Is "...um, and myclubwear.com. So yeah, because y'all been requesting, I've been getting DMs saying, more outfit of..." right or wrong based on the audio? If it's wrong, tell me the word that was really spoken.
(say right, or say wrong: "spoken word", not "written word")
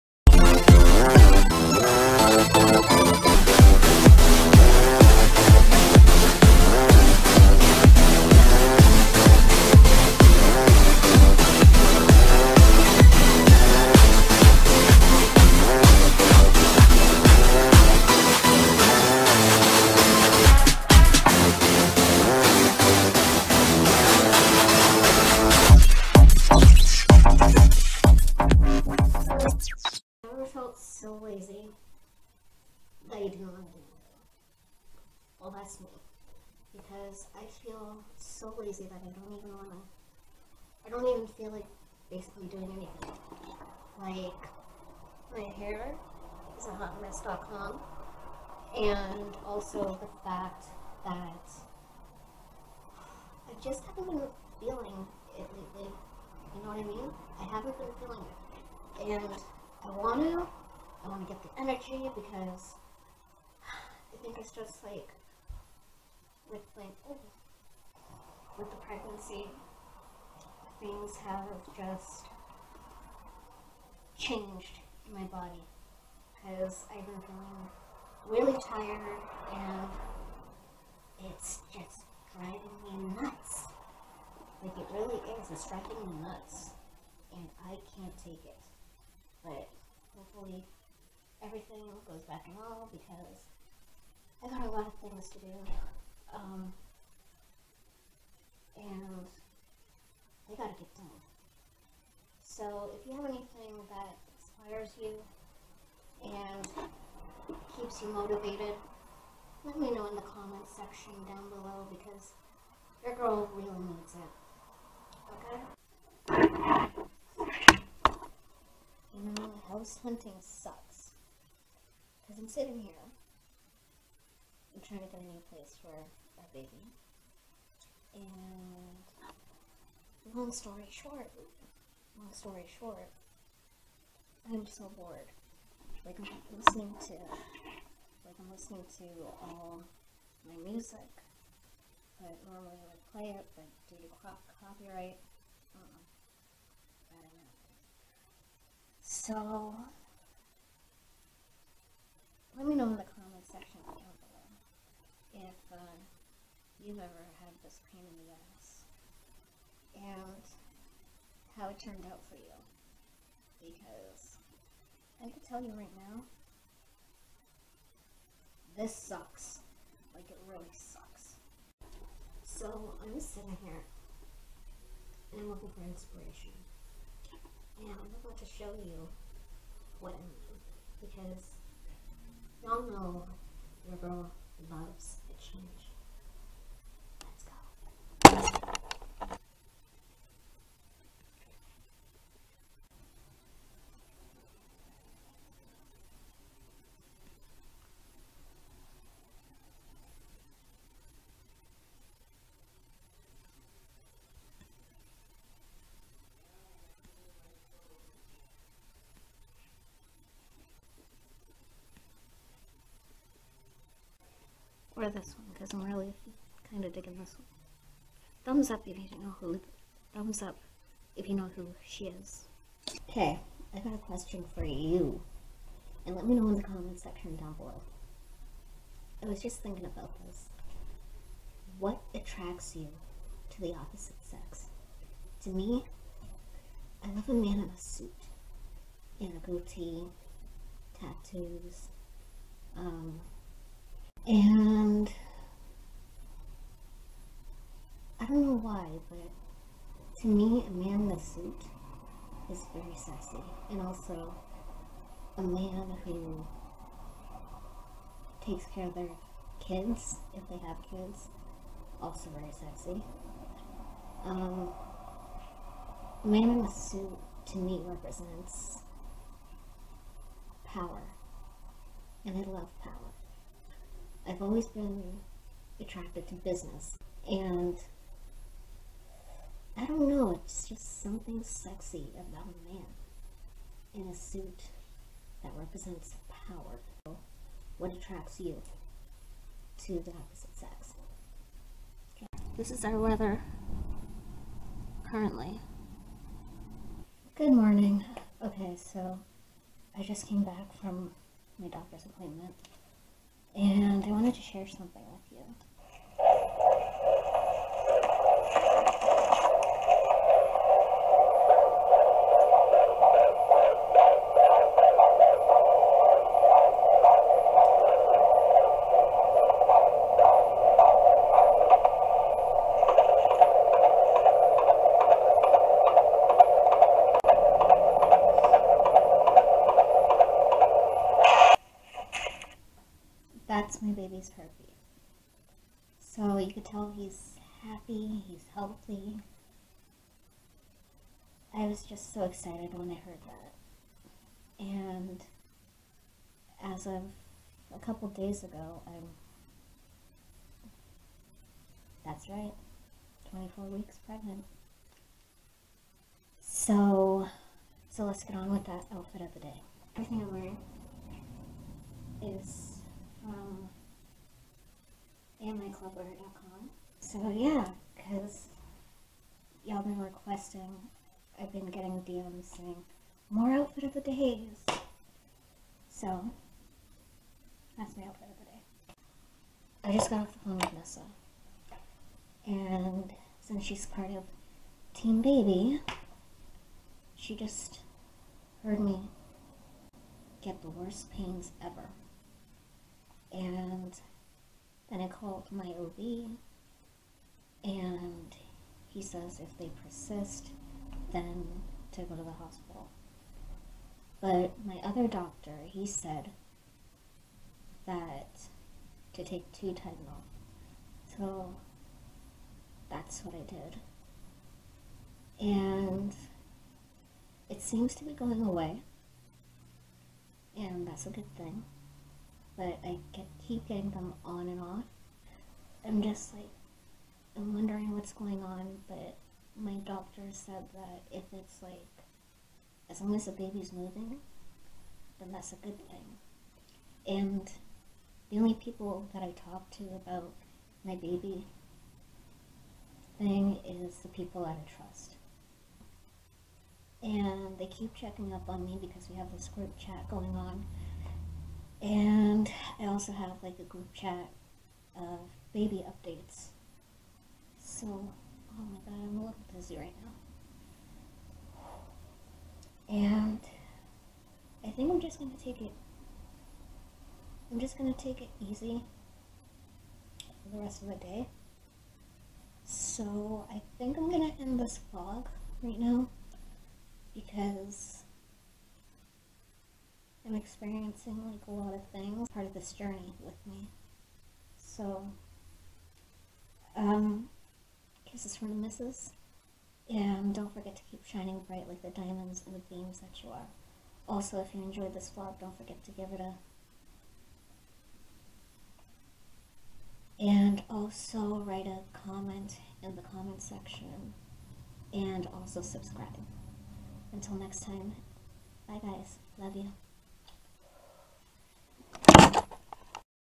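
right.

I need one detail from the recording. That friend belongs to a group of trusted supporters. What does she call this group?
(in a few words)
Team Baby.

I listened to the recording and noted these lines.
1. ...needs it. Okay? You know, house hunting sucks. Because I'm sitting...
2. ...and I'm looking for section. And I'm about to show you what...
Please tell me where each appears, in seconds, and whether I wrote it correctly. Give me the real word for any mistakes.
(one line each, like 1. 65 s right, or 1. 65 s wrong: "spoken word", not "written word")
1. 113 s right
2. 175 s wrong: "inspiration", not "section".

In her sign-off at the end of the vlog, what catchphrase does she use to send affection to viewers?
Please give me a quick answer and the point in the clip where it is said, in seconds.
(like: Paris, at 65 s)
kisses from the misses, at 488 s.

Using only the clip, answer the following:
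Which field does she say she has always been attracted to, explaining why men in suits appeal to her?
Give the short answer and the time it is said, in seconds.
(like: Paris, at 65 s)
business, at 276 s.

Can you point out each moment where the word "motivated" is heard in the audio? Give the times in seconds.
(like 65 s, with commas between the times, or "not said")
108 s.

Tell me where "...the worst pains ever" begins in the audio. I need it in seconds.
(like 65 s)
390 s.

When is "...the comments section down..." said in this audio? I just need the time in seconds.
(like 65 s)
226 s.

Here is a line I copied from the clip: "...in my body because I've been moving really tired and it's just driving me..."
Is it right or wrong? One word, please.
wrong.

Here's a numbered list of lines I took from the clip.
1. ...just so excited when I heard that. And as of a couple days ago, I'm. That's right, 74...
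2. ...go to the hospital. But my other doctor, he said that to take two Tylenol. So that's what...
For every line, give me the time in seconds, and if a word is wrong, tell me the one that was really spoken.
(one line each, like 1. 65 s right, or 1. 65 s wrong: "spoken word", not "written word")
1. 341 s wrong: "24", not "74"
2. 402 s right.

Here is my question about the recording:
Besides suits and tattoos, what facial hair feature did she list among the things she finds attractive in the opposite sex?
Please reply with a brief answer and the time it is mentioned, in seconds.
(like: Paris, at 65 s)
goatee, at 239 s.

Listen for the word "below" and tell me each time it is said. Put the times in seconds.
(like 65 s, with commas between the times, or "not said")
111 s, 227 s.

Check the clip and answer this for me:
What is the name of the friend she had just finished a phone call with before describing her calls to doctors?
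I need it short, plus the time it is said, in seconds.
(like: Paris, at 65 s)
Nessa, at 380 s.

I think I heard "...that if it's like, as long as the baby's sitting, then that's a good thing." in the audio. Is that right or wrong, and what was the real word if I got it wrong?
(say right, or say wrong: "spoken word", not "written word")
wrong: "moving", not "sitting".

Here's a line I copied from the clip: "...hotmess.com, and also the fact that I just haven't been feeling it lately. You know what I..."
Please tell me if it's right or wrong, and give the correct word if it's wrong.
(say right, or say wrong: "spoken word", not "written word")
right.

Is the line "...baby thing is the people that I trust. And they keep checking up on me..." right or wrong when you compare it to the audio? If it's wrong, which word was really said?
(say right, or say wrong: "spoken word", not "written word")
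right.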